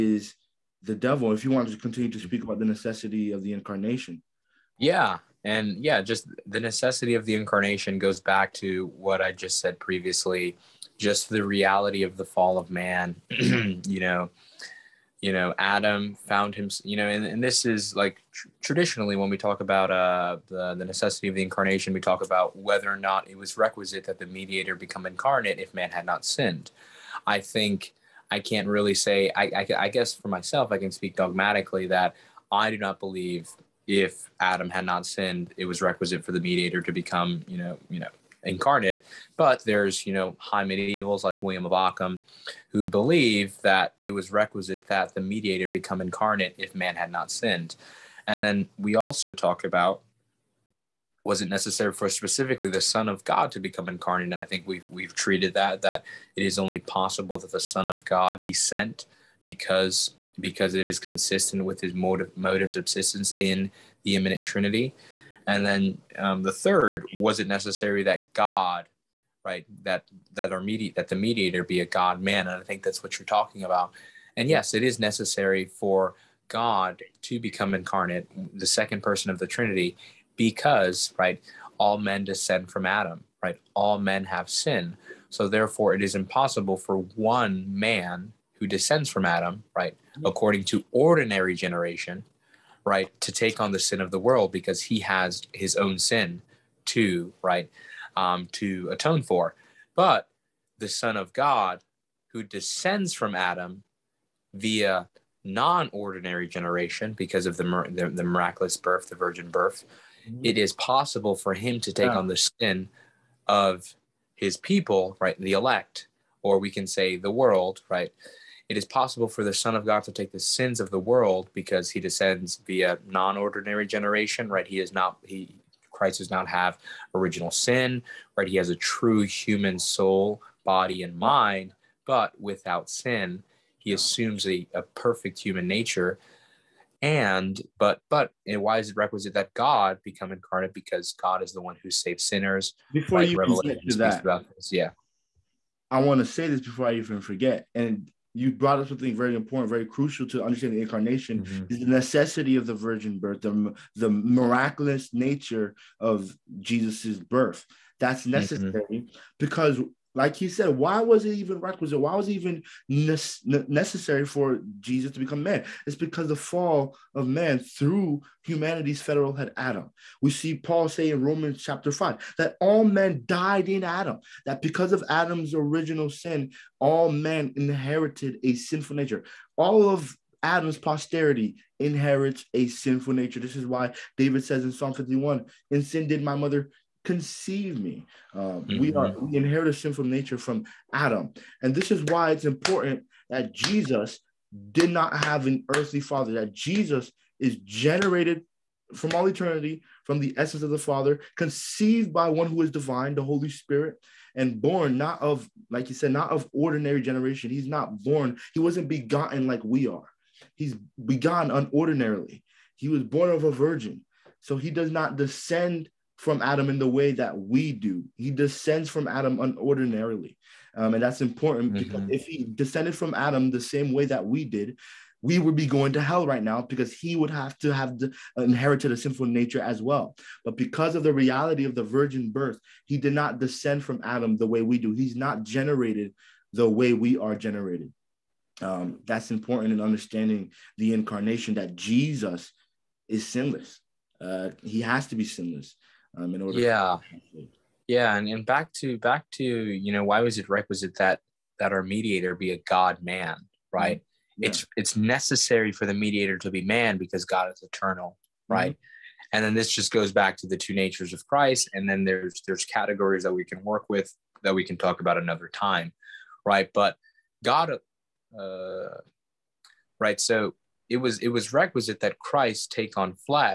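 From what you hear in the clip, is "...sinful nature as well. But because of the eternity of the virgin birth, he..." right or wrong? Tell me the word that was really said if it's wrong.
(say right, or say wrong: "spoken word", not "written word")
wrong: "reality", not "eternity".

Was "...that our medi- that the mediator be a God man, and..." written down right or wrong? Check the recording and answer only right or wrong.
right.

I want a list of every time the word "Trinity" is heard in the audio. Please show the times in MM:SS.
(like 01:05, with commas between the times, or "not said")
01:04, 01:19.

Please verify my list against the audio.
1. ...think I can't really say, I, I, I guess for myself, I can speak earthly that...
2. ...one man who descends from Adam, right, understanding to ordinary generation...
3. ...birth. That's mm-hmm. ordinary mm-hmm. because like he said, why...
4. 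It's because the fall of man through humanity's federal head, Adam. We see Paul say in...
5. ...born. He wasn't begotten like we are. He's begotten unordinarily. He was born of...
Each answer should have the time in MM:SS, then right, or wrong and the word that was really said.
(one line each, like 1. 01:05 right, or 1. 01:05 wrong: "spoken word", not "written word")
1. 00:27 wrong: "dogmatically", not "earthly"
2. 01:26 wrong: "according", not "understanding"
3. 02:37 wrong: "necessary", not "ordinary"
4. 02:45 right
5. 03:28 right.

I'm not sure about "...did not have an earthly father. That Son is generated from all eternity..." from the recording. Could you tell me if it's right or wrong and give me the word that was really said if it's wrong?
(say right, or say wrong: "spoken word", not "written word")
wrong: "Jesus", not "Son".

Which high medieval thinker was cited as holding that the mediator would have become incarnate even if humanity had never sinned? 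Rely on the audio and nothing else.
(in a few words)
William of Ockham.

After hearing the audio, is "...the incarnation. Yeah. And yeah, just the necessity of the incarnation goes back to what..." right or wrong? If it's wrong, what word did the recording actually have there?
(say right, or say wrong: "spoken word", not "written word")
right.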